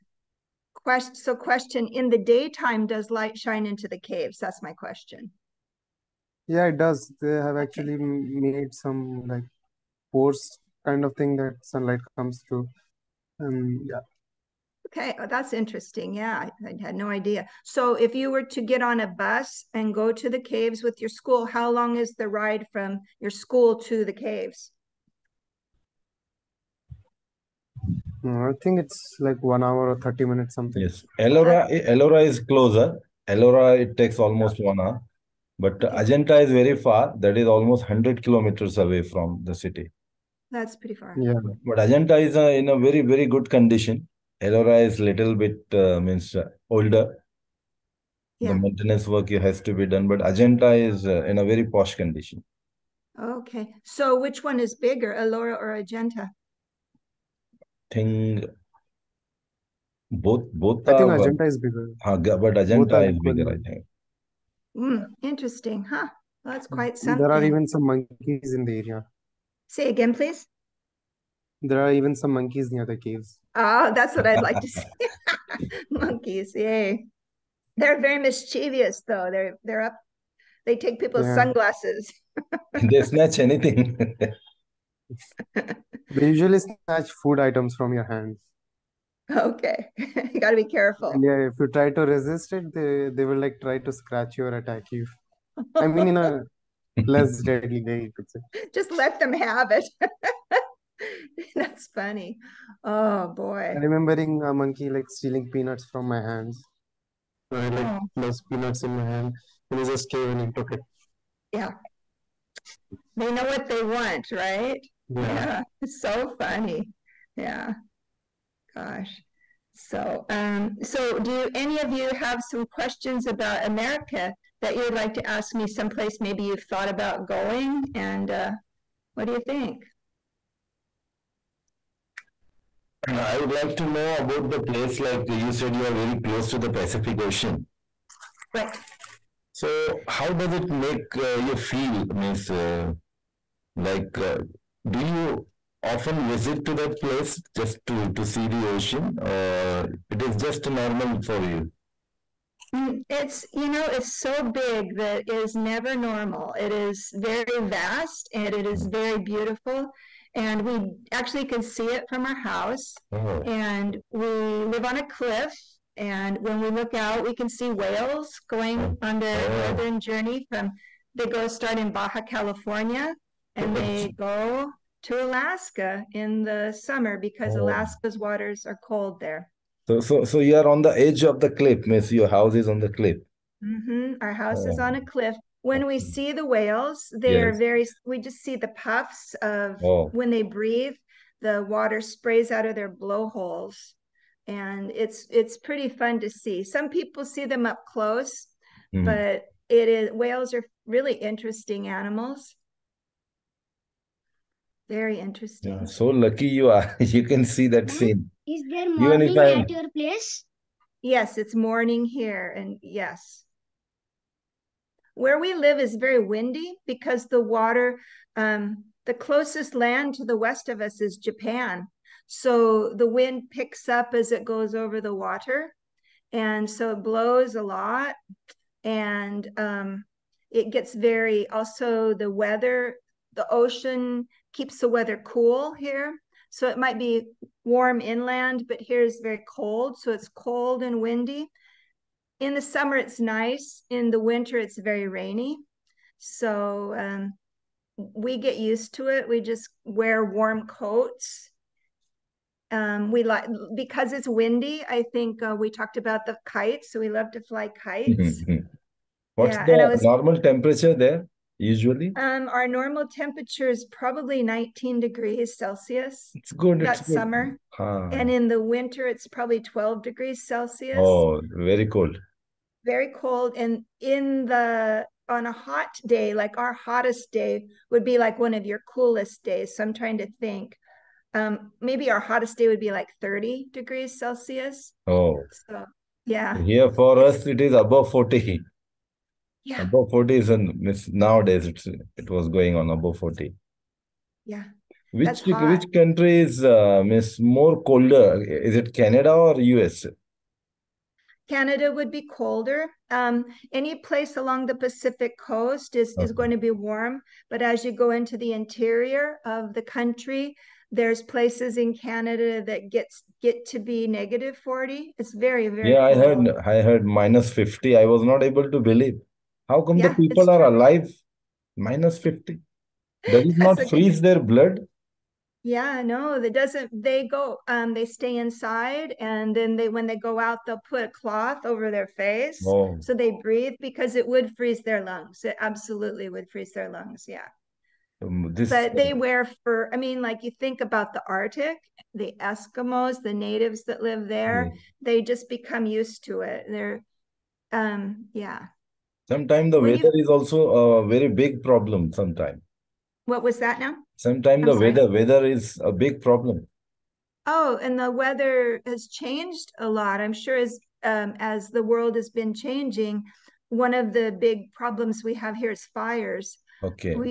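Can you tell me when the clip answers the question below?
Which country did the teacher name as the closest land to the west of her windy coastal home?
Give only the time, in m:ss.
3:41.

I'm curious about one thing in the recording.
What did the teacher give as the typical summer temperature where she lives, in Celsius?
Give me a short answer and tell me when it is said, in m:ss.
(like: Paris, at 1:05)
19 degrees Celsius, at 4:24.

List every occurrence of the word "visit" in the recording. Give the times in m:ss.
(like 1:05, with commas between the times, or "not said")
2:26.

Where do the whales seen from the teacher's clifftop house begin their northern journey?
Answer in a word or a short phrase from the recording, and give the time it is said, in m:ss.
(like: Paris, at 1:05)
Baja California, at 2:51.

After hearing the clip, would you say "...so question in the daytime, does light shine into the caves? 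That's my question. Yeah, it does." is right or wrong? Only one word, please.
right.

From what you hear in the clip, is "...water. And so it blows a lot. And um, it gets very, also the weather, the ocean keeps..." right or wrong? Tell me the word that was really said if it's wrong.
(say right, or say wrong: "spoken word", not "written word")
right.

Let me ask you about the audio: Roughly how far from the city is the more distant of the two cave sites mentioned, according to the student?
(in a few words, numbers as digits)
100 kilometers.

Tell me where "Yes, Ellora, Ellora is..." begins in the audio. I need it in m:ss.
0:30.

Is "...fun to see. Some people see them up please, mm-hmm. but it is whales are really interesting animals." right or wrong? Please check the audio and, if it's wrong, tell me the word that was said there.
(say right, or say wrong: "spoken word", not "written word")
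wrong: "close", not "please".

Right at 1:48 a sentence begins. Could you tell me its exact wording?
those peanuts in my hand and he just came and he took it yeah they know what they want right yeah, yeah.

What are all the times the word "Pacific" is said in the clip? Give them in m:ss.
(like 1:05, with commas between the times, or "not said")
2:16, 5:04.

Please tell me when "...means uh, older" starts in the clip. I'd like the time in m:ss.
0:45.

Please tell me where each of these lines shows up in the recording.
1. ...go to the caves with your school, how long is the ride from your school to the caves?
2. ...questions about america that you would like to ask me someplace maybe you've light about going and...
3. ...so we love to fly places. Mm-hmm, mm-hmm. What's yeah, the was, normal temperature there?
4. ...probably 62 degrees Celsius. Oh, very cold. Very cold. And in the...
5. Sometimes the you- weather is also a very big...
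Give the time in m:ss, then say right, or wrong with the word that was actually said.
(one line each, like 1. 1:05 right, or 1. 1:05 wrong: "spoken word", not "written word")
1. 0:19 right
2. 2:02 wrong: "thought", not "light"
3. 4:16 wrong: "kites", not "places"
4. 4:29 wrong: "12", not "62"
5. 5:49 right.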